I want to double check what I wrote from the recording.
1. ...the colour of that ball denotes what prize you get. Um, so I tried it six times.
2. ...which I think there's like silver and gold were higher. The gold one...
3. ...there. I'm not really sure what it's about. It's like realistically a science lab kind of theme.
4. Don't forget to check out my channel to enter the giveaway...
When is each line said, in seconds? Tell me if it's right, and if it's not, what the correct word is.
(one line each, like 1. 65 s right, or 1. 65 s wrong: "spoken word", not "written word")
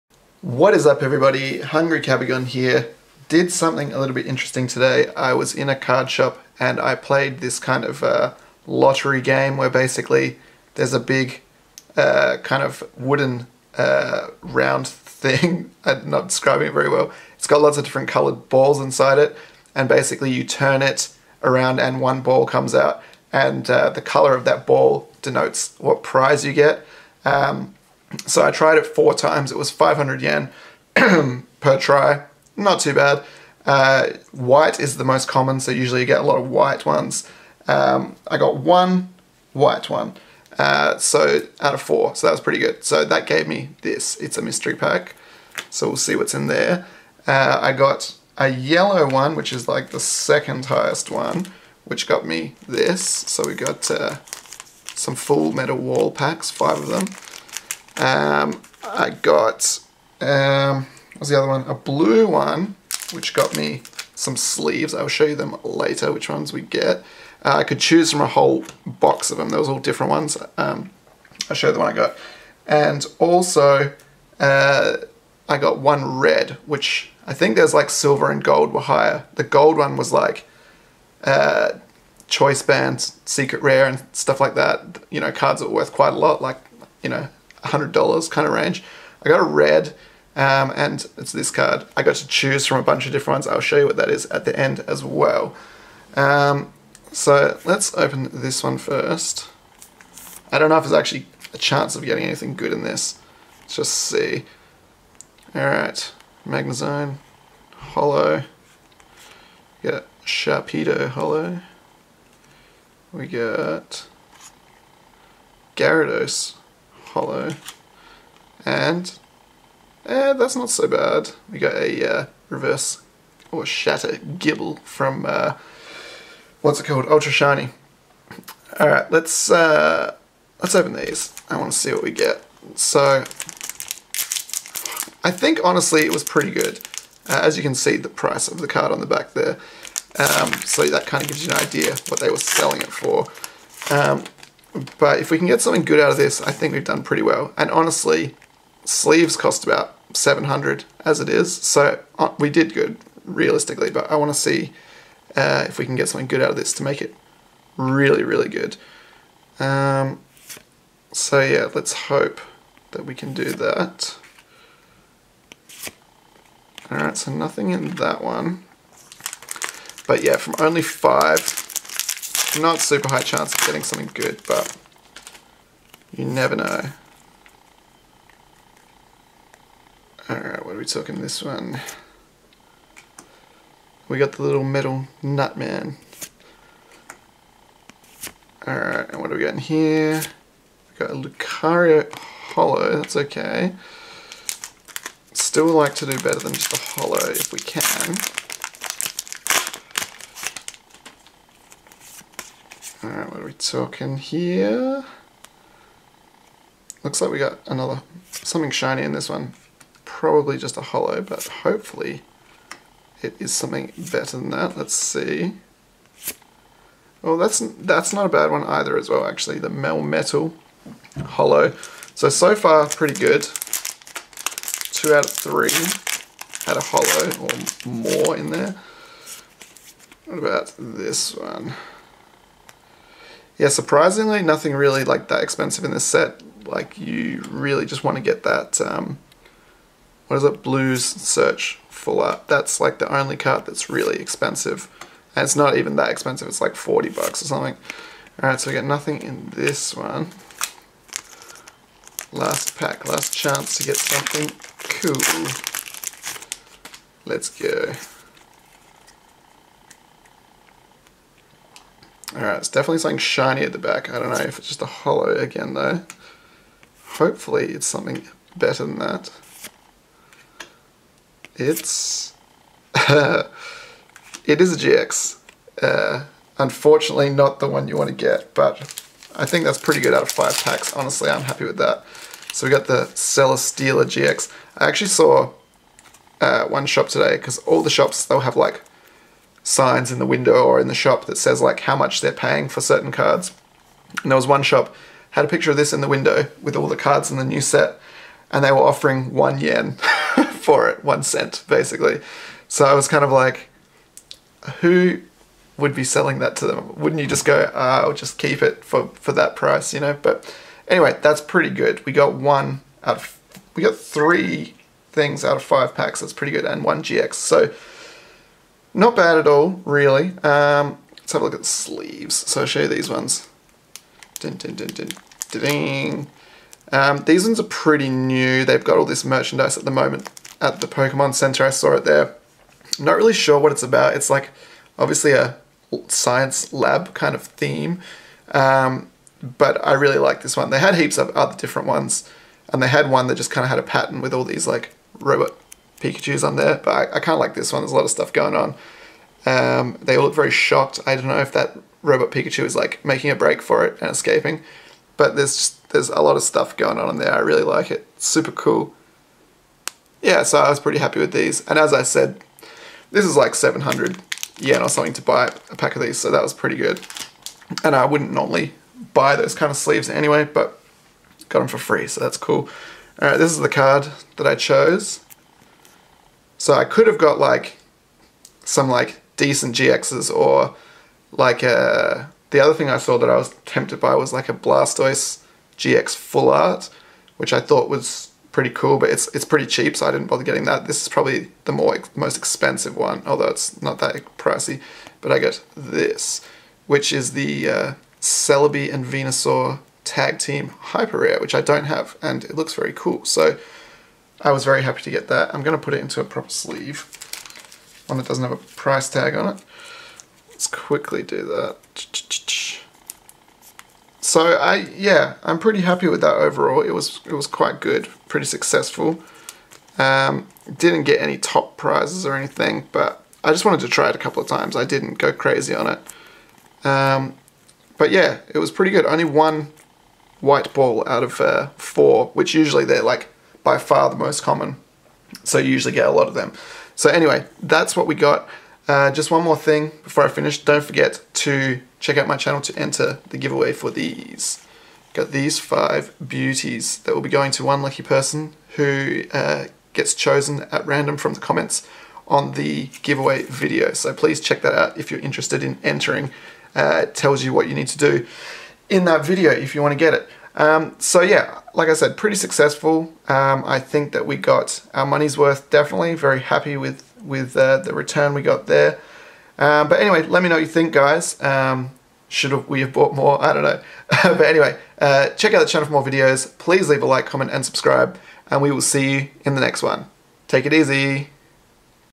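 1. 23 s wrong: "four", not "six"
2. 76 s right
3. 332 s wrong: "obviously", not "realistically"
4. 440 s right.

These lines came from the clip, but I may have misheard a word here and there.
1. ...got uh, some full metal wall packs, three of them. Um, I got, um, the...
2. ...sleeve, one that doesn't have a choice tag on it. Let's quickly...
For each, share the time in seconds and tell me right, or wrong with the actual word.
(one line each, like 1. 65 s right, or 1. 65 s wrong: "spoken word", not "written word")
1. 53 s wrong: "five", not "three"
2. 406 s wrong: "price", not "choice".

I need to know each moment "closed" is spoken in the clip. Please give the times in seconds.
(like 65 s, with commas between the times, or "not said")
not said.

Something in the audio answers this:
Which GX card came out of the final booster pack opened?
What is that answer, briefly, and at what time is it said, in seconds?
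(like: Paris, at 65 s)
Celesteela GX, at 283 s.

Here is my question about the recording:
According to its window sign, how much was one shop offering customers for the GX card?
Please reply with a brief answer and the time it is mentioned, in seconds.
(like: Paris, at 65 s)
1 yen, at 299 s.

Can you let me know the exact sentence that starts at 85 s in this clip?
You know, cards that were worth quite a lot, like, you know, $100 kind of range.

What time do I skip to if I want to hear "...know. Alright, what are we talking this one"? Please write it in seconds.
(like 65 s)
176 s.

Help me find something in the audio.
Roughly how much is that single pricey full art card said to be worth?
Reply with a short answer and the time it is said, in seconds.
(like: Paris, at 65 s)
40 bucks, at 246 s.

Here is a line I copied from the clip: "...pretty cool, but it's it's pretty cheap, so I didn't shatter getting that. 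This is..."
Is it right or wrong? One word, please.
wrong.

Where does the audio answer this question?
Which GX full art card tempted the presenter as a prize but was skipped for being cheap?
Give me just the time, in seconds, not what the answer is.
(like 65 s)
384 s.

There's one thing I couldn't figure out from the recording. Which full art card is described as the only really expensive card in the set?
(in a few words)
Blues Search.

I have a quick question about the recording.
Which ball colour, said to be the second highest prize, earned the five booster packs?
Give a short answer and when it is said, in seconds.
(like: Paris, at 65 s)
yellow, at 48 s.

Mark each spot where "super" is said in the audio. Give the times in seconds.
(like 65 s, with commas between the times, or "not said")
172 s, 358 s.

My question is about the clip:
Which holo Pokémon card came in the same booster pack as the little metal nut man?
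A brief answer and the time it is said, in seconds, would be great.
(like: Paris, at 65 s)
Lucario, at 191 s.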